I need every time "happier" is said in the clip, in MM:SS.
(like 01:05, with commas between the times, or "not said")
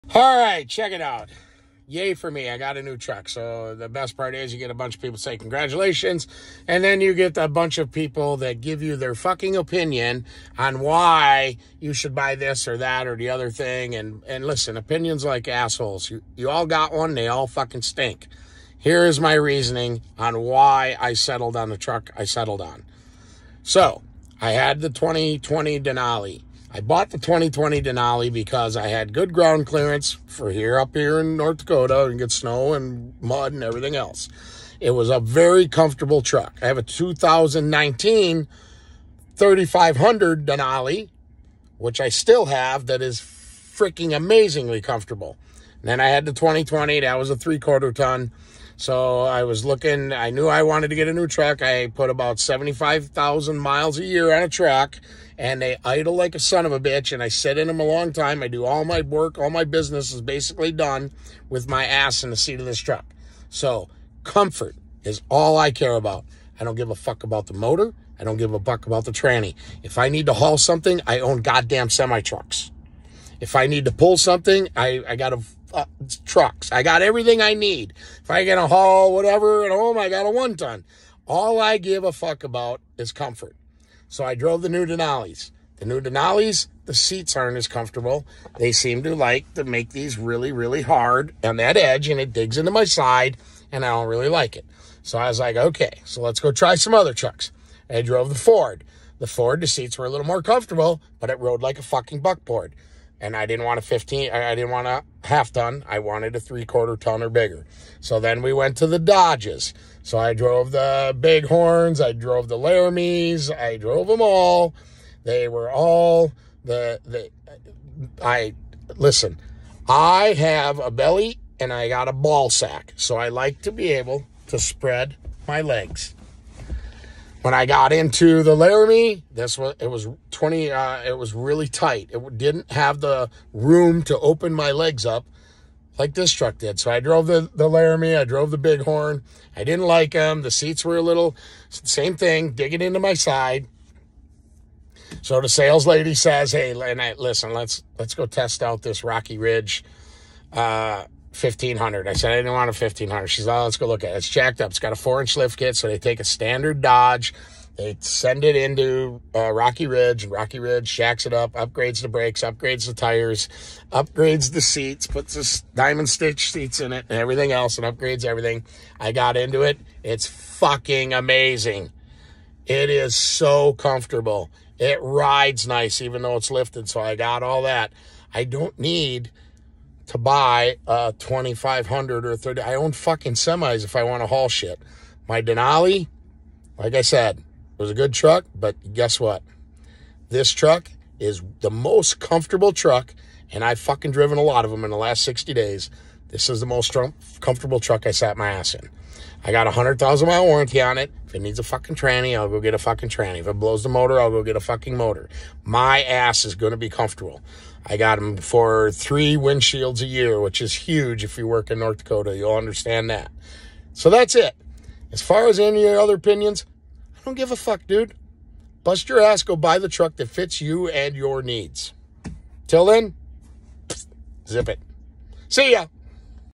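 not said.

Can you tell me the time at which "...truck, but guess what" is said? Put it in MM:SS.
03:08.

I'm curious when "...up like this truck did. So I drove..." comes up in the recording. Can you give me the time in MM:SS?
02:15.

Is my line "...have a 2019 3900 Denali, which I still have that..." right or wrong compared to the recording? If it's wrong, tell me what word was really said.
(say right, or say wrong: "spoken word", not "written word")
wrong: "3500", not "3900".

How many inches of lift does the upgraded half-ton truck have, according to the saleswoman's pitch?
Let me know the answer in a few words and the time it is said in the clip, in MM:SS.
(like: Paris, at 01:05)
4 inches, at 02:34.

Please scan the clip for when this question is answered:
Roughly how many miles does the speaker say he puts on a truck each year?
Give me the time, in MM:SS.
00:52.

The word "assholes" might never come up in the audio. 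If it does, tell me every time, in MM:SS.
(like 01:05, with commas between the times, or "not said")
00:15.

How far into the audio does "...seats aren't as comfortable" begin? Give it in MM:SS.
01:26.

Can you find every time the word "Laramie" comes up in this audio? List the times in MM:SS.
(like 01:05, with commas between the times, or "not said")
01:52, 02:08, 02:17.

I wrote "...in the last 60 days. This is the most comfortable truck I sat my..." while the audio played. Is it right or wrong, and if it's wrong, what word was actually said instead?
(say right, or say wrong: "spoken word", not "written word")
right.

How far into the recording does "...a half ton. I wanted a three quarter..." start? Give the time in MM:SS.
01:44.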